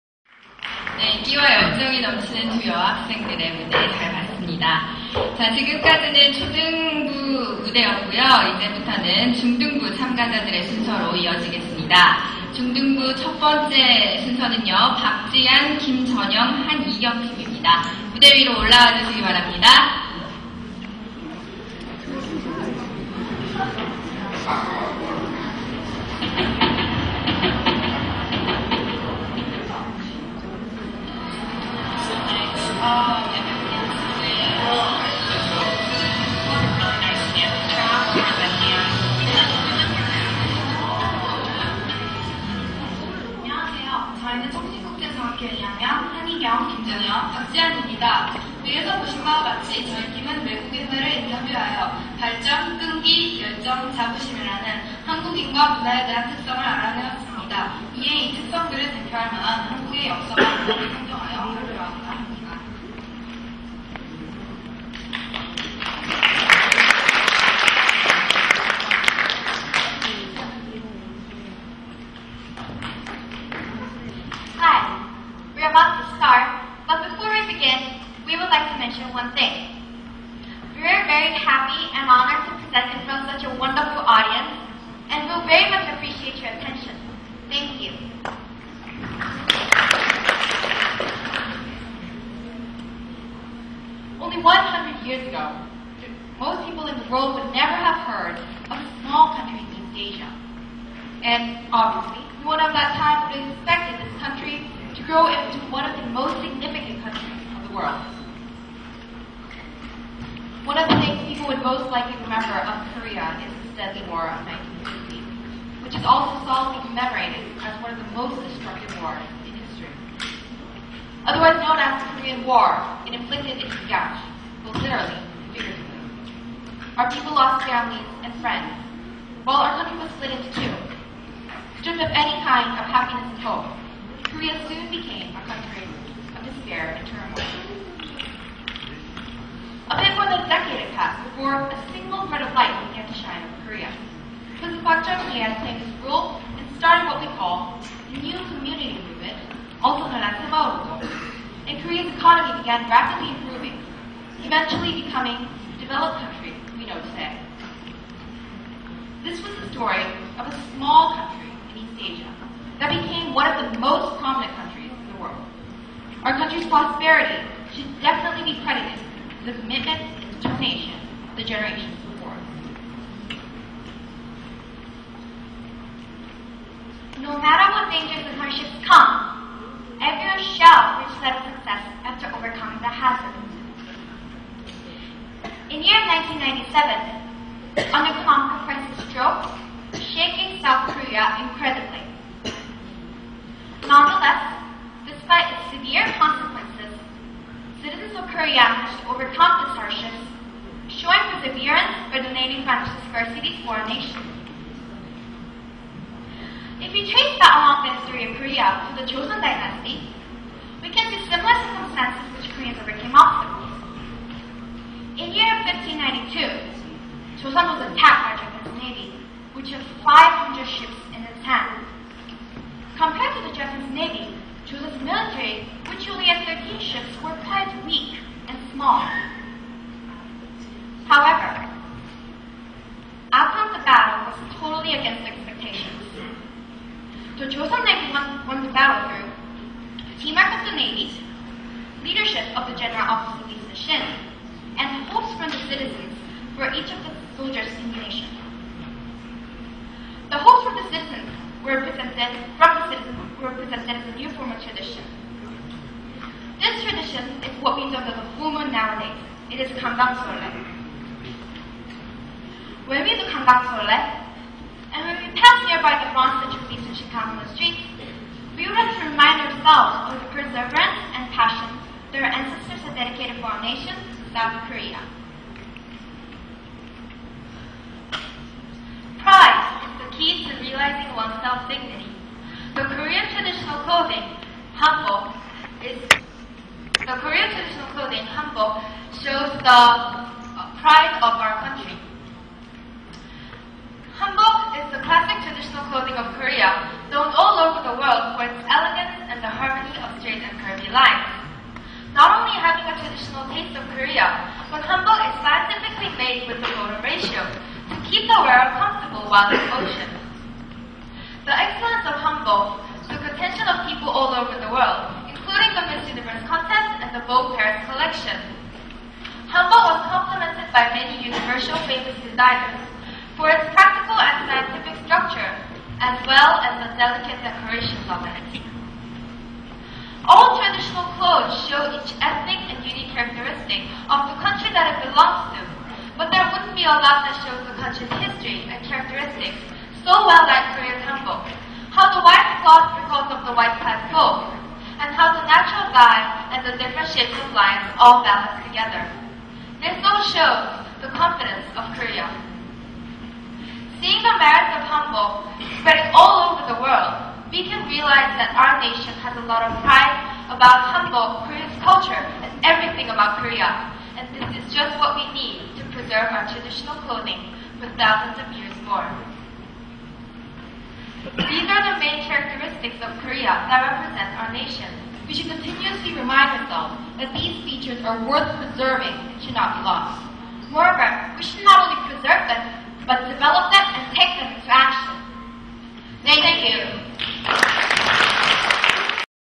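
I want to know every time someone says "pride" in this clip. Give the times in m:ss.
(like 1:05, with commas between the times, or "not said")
4:39, 4:50, 5:59.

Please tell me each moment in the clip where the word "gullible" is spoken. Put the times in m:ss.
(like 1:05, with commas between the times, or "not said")
not said.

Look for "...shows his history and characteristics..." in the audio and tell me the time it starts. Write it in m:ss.
5:37.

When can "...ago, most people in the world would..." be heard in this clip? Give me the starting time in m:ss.
1:35.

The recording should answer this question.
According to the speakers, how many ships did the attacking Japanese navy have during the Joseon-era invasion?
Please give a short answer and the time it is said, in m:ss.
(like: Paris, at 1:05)
500, at 3:40.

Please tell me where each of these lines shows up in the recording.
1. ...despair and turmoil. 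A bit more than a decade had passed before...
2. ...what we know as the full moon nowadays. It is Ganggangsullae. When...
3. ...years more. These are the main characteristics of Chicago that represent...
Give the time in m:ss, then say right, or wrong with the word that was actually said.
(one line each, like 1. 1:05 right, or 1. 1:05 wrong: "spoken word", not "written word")
1. 2:16 right
2. 4:17 right
3. 6:08 wrong: "Korea", not "Chicago".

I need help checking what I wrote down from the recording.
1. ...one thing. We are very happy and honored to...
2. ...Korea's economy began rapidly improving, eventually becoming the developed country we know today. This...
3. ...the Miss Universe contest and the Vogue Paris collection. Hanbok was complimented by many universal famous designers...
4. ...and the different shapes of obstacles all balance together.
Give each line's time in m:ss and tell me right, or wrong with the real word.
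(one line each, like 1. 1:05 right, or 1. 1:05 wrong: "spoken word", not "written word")
1. 1:19 right
2. 2:31 right
3. 5:15 right
4. 5:46 wrong: "lines", not "obstacles".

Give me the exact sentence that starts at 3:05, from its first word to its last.
In year 1997, under Command Francis Stroke, shaking South Korea incredibly.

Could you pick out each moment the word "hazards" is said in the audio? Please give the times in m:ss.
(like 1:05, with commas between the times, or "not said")
3:02.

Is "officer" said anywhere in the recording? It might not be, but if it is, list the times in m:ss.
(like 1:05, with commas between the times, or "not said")
4:03.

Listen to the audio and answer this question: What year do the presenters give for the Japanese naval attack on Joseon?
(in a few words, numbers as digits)
1592.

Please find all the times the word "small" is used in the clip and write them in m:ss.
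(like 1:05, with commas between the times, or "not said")
1:39, 2:40, 3:48.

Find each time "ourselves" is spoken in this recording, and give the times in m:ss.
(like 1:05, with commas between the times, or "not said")
4:29, 6:16.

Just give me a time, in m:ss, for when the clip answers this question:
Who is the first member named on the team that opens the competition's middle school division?
0:14.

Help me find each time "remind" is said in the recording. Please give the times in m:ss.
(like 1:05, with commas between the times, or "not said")
4:29, 6:16.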